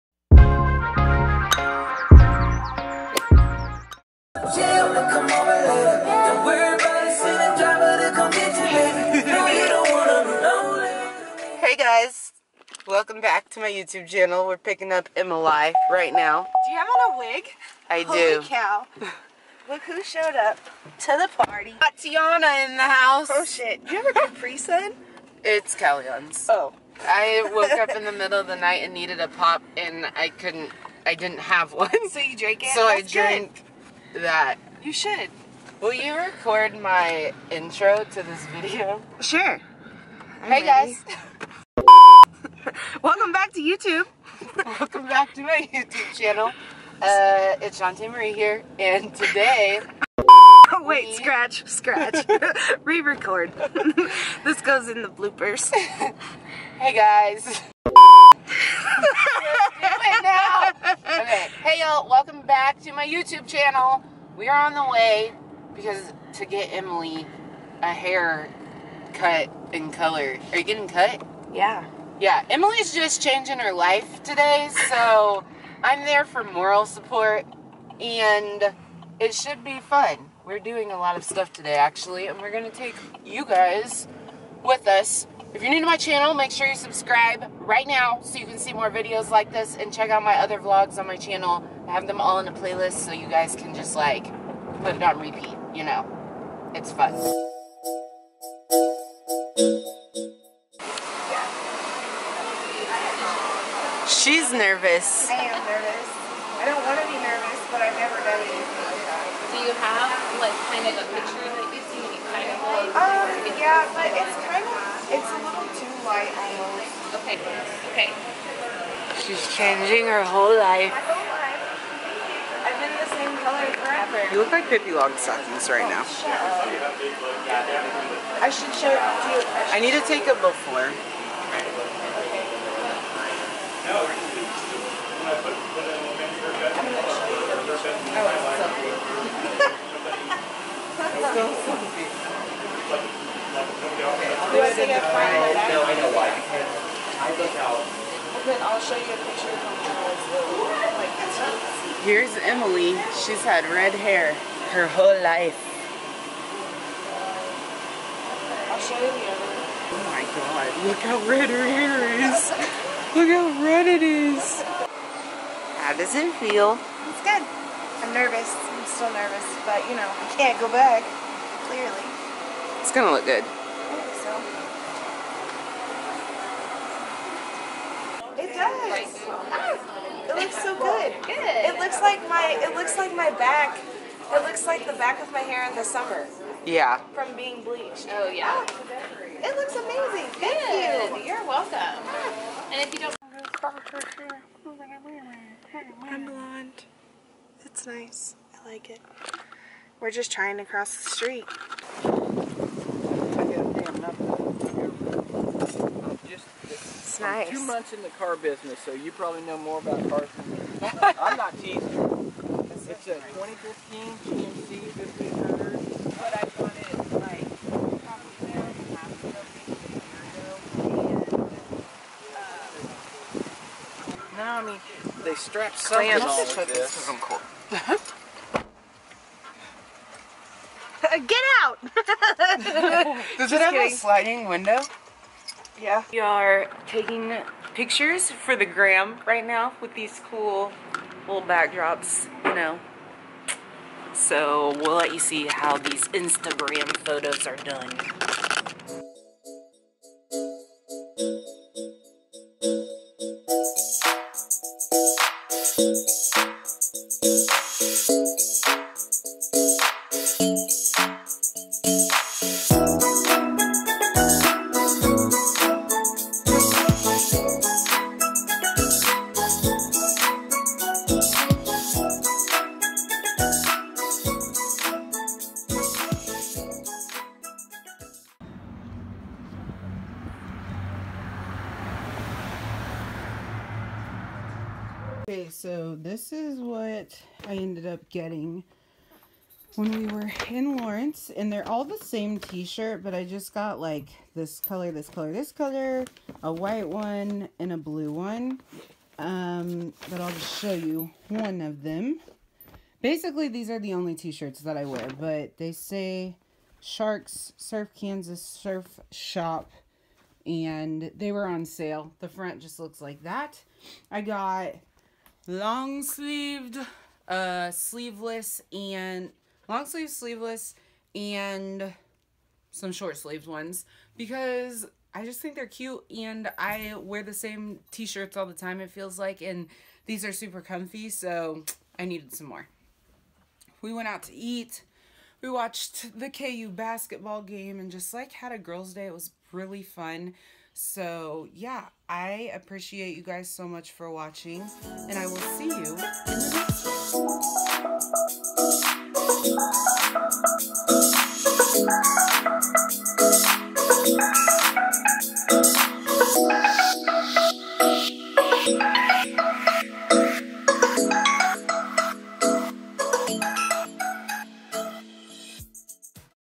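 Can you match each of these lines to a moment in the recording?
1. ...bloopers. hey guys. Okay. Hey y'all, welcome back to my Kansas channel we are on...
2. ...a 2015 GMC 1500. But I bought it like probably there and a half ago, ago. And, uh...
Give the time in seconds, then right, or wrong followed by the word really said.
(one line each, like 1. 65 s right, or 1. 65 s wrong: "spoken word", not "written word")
1. 55 s wrong: "YouTube", not "Kansas"
2. 213 s right.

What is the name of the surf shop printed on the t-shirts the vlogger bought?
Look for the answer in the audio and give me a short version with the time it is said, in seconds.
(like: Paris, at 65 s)
Sharks Surf Kansas Surf Shop, at 306 s.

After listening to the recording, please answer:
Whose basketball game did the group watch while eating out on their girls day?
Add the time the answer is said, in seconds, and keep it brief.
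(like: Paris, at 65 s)
KU, at 336 s.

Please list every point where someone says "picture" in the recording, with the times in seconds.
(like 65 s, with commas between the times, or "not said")
111 s, 149 s, 237 s.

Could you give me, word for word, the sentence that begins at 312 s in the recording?
The front just looks like that.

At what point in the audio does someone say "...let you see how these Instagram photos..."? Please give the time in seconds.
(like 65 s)
244 s.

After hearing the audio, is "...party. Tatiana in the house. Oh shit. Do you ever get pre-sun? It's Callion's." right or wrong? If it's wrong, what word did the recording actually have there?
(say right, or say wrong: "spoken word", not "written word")
right.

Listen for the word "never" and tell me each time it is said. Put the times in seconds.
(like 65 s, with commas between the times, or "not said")
107 s.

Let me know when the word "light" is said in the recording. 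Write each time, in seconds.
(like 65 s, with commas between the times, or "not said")
116 s.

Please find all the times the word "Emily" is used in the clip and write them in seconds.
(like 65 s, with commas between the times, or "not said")
15 s, 66 s, 72 s, 152 s.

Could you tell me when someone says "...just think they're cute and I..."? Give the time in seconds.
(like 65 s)
325 s.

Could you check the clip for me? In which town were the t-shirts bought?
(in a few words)
Lawrence.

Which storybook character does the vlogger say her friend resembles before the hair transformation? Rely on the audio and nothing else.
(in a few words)
Pippi Longstockings.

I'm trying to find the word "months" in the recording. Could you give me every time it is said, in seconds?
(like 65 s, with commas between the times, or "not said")
207 s.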